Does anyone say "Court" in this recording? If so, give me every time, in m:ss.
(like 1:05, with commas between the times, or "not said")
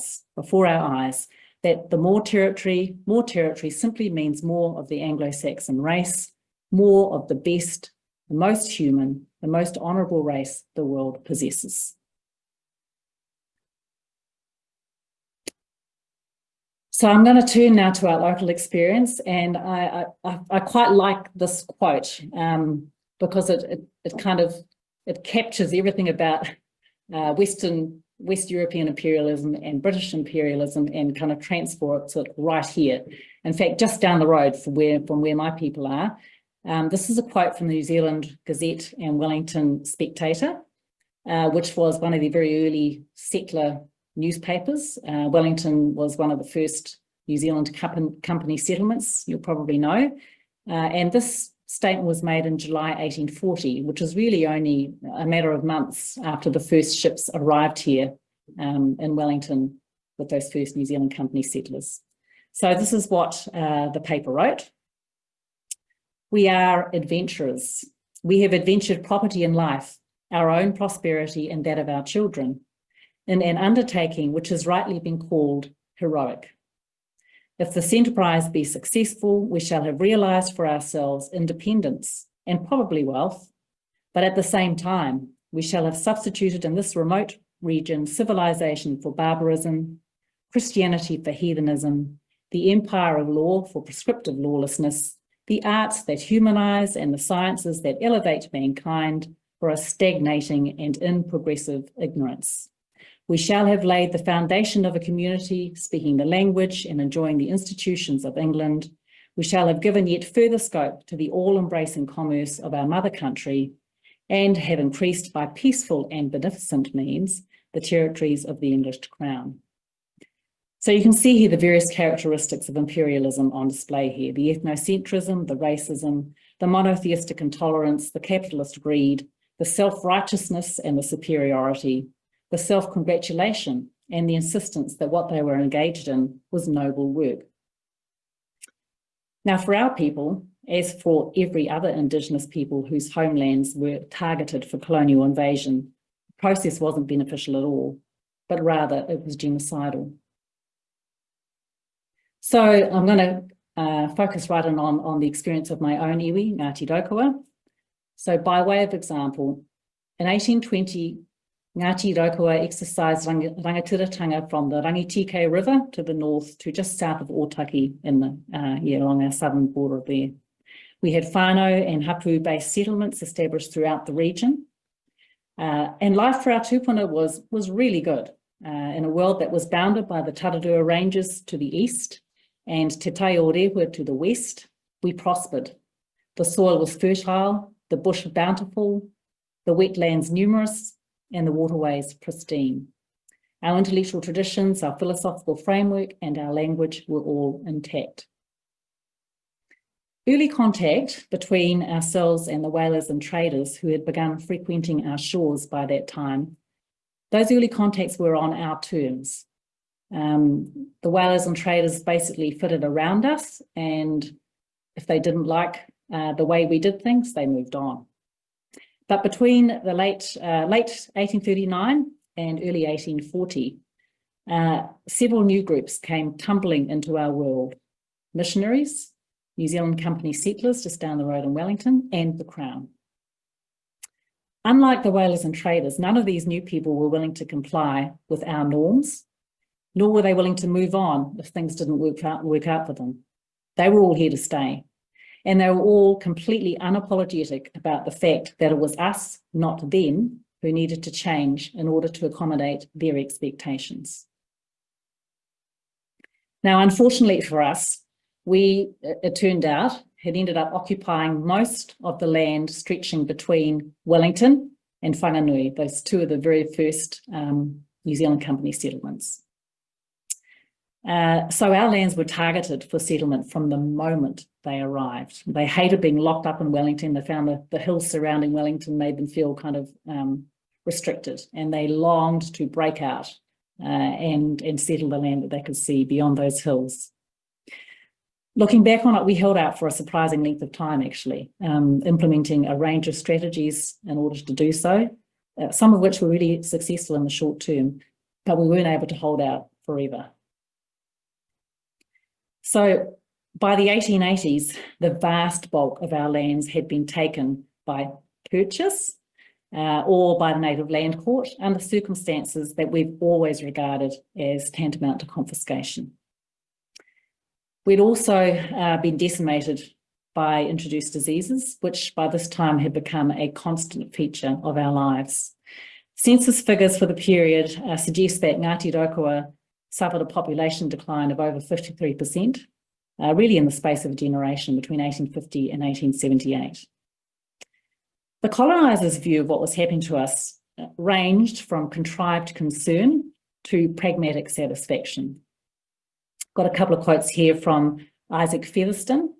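5:11.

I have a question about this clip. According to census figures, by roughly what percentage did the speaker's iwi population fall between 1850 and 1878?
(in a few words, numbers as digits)
over 53%.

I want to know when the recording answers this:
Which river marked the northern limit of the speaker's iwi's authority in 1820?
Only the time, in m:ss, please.
2:44.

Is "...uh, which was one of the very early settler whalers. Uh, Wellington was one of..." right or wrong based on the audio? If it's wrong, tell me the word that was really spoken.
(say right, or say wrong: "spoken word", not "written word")
wrong: "newspapers", not "whalers".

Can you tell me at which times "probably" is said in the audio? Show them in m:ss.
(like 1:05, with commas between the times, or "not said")
0:49, 1:22.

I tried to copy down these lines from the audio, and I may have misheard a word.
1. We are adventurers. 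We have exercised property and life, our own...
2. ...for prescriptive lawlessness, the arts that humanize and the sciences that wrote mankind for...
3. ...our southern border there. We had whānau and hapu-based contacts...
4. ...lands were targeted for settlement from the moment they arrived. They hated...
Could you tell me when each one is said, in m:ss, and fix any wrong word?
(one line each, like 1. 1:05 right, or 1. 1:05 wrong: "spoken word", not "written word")
1. 1:06 wrong: "adventured", not "exercised"
2. 1:33 wrong: "elevate", not "wrote"
3. 2:49 wrong: "settlements", not "contacts"
4. 4:31 right.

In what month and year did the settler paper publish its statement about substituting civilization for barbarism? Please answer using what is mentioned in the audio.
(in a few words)
July 1840.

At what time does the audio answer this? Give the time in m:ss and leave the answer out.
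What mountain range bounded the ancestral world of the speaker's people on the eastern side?
3:00.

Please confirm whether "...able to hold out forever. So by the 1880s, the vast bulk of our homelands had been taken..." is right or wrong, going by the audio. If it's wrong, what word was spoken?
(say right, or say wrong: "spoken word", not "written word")
wrong: "lands", not "homelands".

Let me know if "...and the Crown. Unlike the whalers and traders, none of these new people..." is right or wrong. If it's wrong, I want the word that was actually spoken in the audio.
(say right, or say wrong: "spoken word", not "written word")
right.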